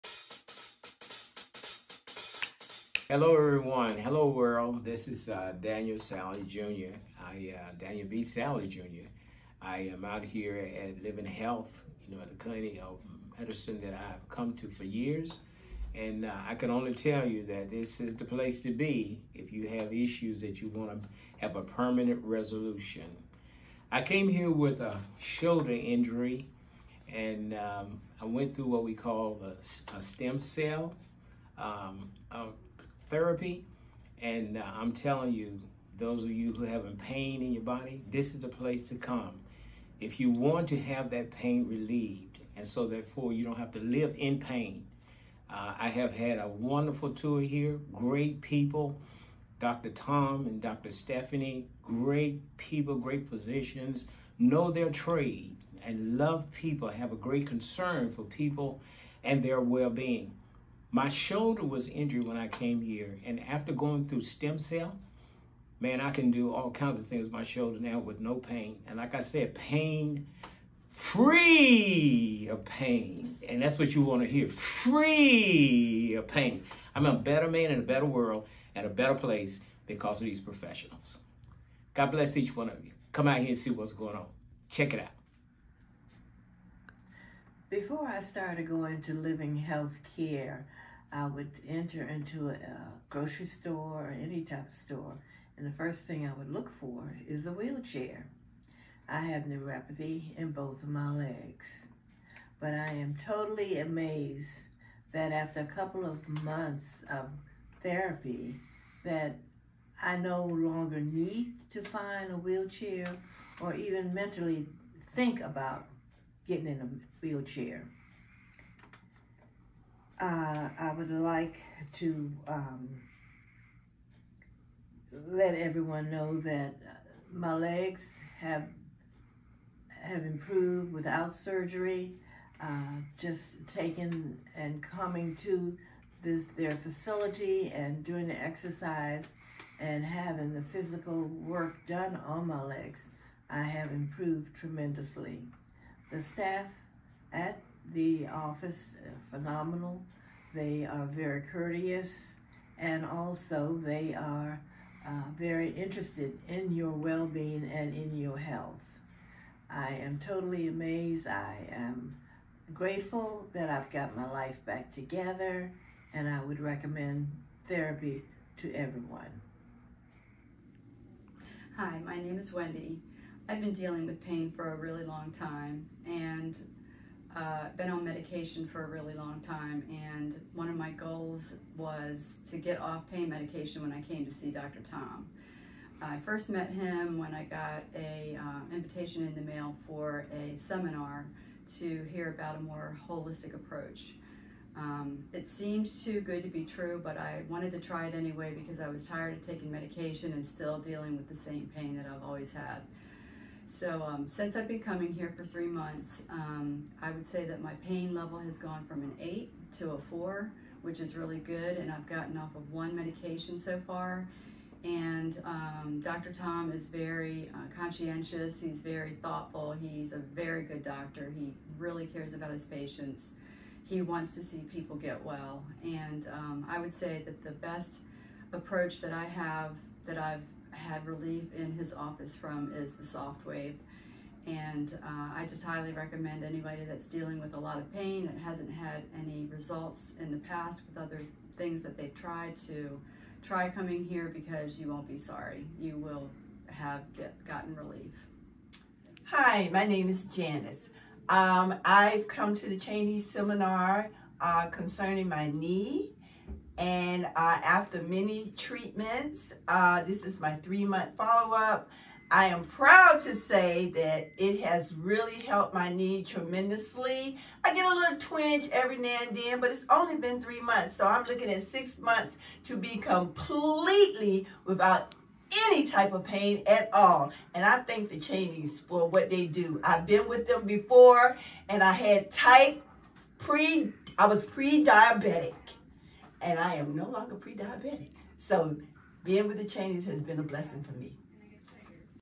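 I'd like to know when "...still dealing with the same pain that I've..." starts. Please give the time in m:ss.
3:20.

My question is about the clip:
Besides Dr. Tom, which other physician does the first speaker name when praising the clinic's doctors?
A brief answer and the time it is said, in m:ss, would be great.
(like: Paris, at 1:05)
Dr. Stephanie, at 0:50.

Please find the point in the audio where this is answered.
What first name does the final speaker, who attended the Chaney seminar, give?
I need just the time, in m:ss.
4:10.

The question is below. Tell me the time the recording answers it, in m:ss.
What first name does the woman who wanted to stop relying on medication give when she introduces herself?
2:52.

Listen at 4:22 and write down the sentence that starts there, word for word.
I am proud to say that it has really helped my knee tremendously.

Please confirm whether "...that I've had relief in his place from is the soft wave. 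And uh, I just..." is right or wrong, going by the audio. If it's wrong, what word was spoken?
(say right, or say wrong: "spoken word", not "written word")
wrong: "office", not "place".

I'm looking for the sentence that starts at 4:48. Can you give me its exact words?
So being with the Chaneys has been a blessing for me.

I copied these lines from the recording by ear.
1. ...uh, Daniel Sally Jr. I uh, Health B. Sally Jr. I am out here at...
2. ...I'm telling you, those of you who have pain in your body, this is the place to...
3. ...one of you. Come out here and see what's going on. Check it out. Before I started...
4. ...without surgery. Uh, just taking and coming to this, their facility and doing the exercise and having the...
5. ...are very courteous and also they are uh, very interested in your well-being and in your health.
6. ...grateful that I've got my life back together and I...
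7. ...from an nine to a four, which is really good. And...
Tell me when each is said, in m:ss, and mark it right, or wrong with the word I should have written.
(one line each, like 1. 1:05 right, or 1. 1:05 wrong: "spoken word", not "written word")
1. 0:05 wrong: "Daniel", not "Health"
2. 0:34 right
3. 1:22 right
4. 2:10 right
5. 2:30 right
6. 2:42 right
7. 3:28 wrong: "eight", not "nine".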